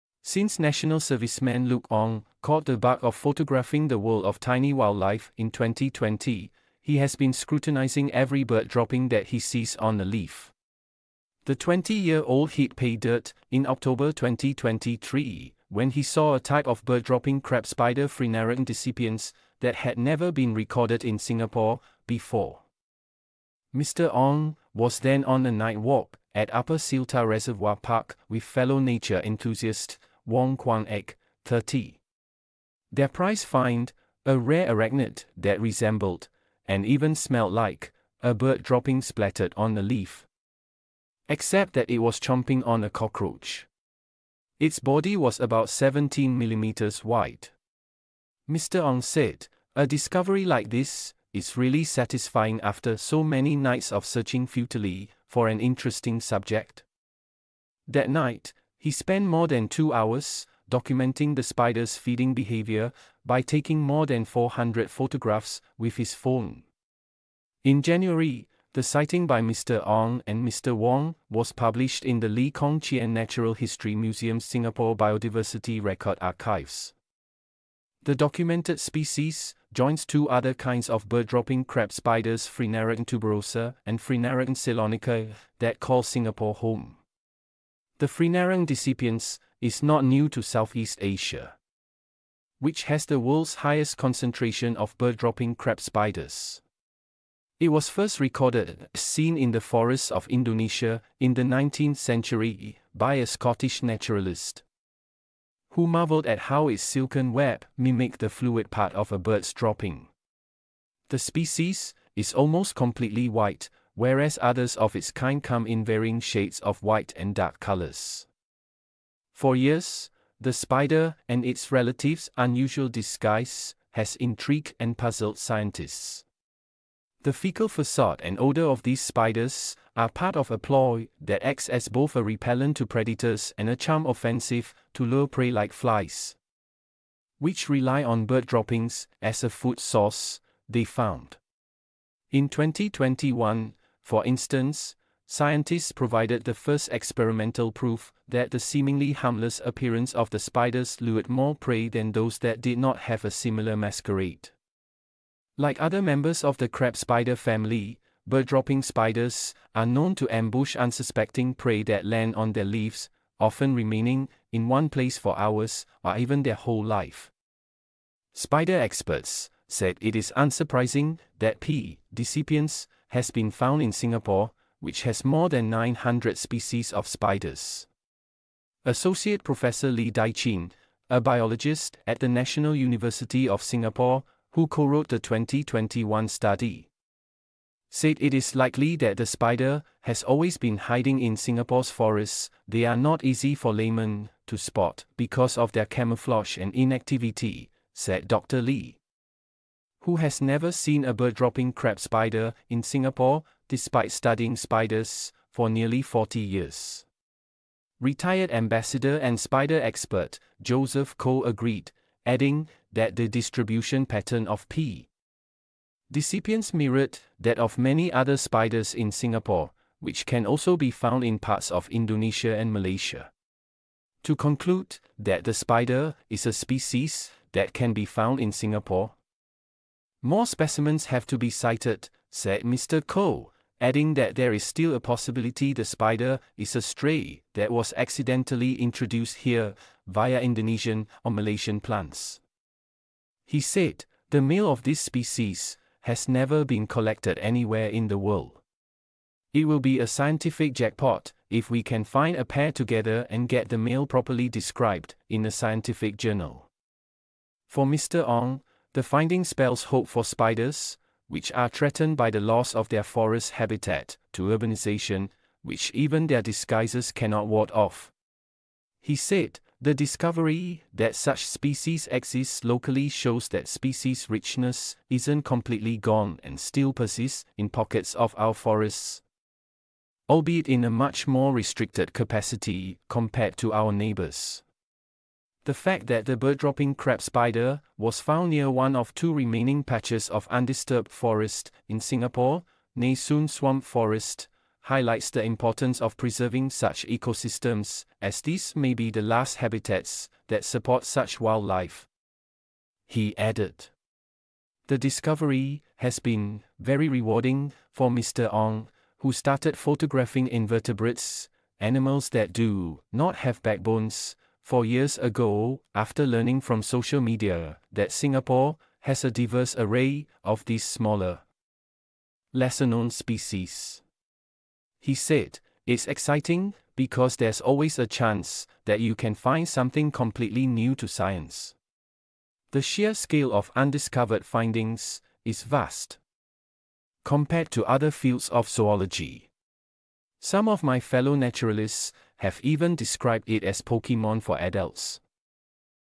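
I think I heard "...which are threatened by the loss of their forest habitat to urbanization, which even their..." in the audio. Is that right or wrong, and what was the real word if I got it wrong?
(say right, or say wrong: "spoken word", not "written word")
right.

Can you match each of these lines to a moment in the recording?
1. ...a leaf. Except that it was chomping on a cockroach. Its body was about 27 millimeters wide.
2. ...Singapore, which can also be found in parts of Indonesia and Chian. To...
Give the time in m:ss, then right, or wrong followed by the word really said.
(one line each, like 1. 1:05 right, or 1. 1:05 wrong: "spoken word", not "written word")
1. 0:39 wrong: "17", not "27"
2. 3:39 wrong: "Malaysia", not "Chian".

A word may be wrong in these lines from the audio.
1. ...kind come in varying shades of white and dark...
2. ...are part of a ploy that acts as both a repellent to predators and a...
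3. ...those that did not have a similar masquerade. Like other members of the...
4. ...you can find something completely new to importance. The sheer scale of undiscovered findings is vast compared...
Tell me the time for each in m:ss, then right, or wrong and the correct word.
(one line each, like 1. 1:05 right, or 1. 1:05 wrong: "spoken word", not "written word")
1. 1:55 right
2. 2:09 right
3. 2:32 right
4. 5:29 wrong: "science", not "importance".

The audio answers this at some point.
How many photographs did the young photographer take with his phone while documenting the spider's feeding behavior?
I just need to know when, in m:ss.
1:04.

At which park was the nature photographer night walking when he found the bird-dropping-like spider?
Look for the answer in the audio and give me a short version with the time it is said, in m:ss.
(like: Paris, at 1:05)
Upper Seletar Reservoir Park, at 0:26.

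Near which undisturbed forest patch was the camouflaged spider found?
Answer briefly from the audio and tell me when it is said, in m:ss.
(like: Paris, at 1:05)
Nee Soon Swamp Forest, at 4:52.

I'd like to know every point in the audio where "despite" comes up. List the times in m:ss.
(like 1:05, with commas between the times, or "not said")
3:23.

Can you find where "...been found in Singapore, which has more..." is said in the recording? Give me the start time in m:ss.
2:53.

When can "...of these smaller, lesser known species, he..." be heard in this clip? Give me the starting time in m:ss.
5:20.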